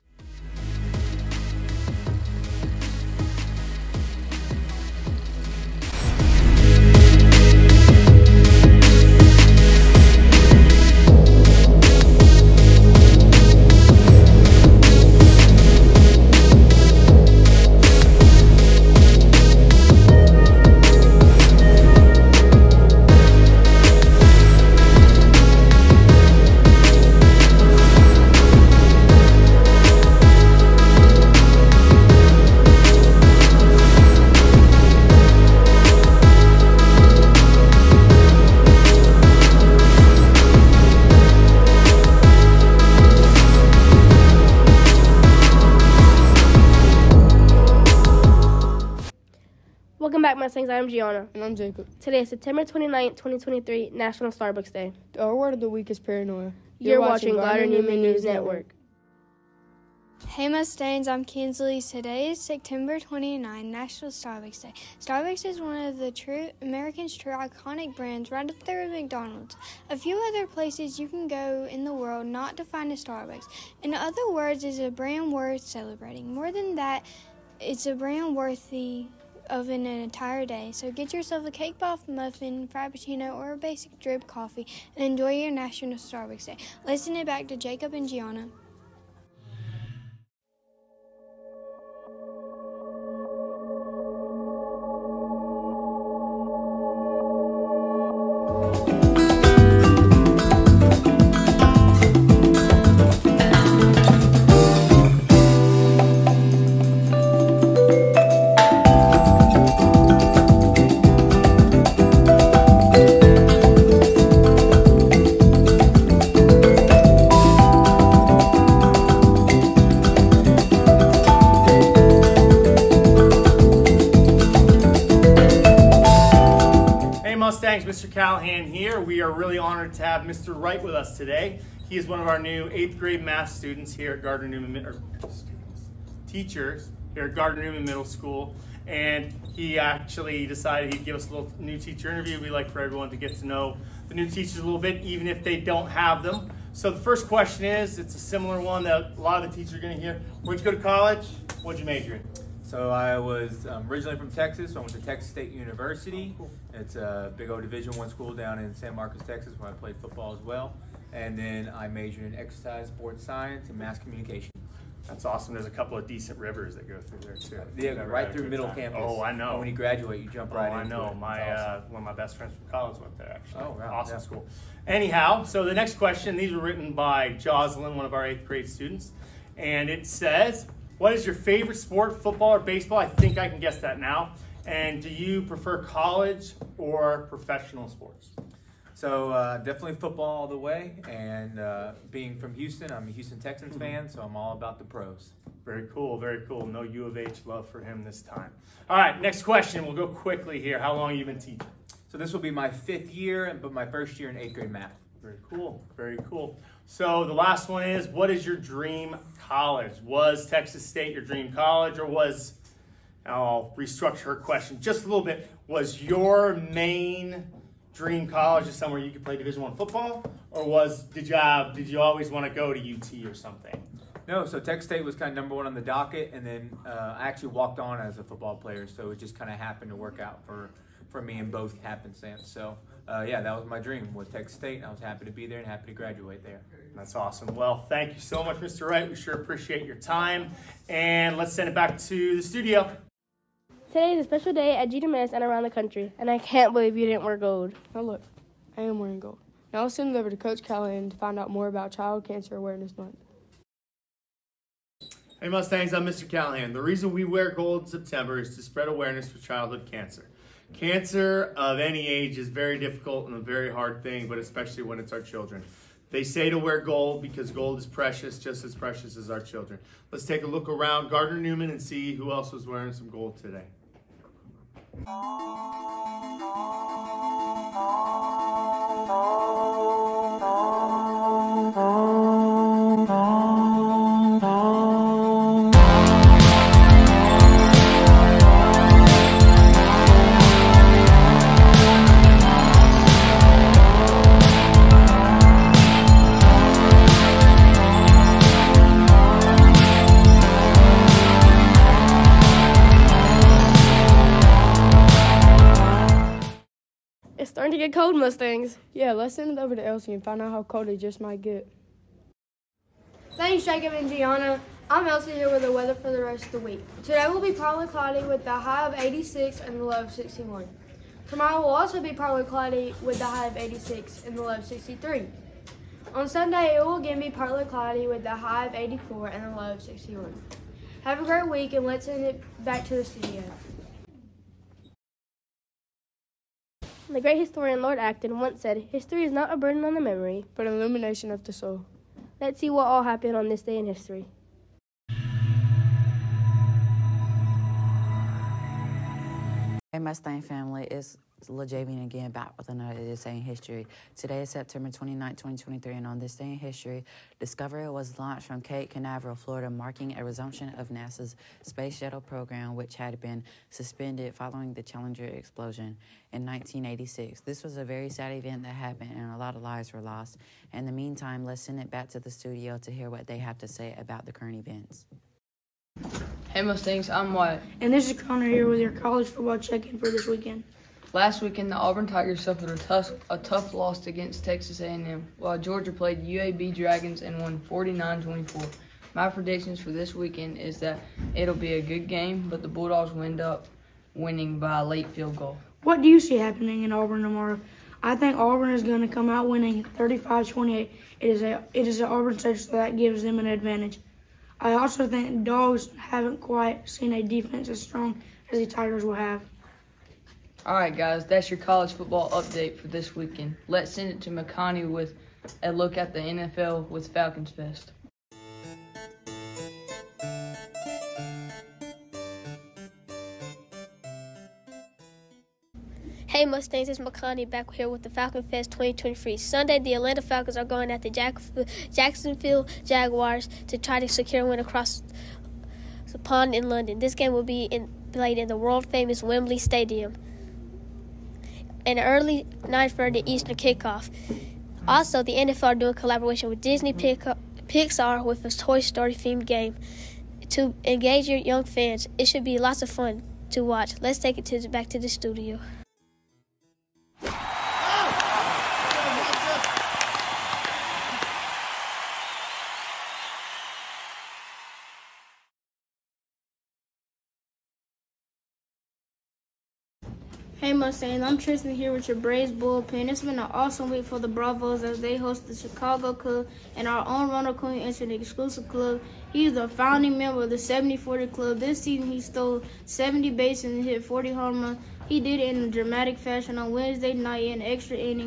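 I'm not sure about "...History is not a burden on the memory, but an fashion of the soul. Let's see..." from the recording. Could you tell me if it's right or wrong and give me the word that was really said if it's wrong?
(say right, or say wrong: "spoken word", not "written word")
wrong: "illumination", not "fashion".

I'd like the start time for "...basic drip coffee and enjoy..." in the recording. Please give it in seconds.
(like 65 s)
83 s.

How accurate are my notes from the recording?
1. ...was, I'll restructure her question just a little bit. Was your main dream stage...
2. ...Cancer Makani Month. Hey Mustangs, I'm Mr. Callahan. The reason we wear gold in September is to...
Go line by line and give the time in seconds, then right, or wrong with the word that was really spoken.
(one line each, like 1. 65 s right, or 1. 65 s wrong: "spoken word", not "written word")
1. 212 s wrong: "college", not "stage"
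2. 252 s wrong: "Awareness", not "Makani".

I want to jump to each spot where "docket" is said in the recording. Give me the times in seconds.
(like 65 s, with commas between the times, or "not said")
225 s.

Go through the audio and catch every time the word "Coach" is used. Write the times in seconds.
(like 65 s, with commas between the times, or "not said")
250 s.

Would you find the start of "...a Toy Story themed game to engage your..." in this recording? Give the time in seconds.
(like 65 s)
448 s.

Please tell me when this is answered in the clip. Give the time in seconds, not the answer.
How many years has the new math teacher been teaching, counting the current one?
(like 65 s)
202 s.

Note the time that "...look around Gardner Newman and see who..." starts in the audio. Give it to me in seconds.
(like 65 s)
270 s.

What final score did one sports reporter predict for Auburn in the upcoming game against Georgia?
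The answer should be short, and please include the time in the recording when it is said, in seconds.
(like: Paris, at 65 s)
35-28, at 399 s.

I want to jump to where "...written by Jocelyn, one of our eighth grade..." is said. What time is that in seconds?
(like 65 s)
176 s.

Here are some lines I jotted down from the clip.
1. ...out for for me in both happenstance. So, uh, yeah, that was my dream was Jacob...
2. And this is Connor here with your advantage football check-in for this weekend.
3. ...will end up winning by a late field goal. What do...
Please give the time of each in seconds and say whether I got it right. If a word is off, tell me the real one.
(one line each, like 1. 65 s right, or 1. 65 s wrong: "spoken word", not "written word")
1. 230 s wrong: "Texas", not "Jacob"
2. 377 s wrong: "college", not "advantage"
3. 393 s right.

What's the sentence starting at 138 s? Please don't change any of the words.
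And he actually decided he'd give us a little new teacher interview.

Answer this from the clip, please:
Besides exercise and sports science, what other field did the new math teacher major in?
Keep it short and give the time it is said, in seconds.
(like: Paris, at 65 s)
mass communication, at 163 s.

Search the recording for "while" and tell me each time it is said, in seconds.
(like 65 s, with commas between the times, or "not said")
385 s.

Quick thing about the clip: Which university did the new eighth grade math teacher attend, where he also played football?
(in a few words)
Texas State University.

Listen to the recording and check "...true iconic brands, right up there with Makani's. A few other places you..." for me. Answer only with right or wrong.
wrong.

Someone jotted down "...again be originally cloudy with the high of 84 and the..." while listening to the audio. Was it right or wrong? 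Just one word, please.
wrong.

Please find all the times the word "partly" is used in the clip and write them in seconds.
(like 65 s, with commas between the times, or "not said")
317 s, 322 s, 327 s.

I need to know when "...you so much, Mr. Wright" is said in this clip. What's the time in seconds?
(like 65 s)
238 s.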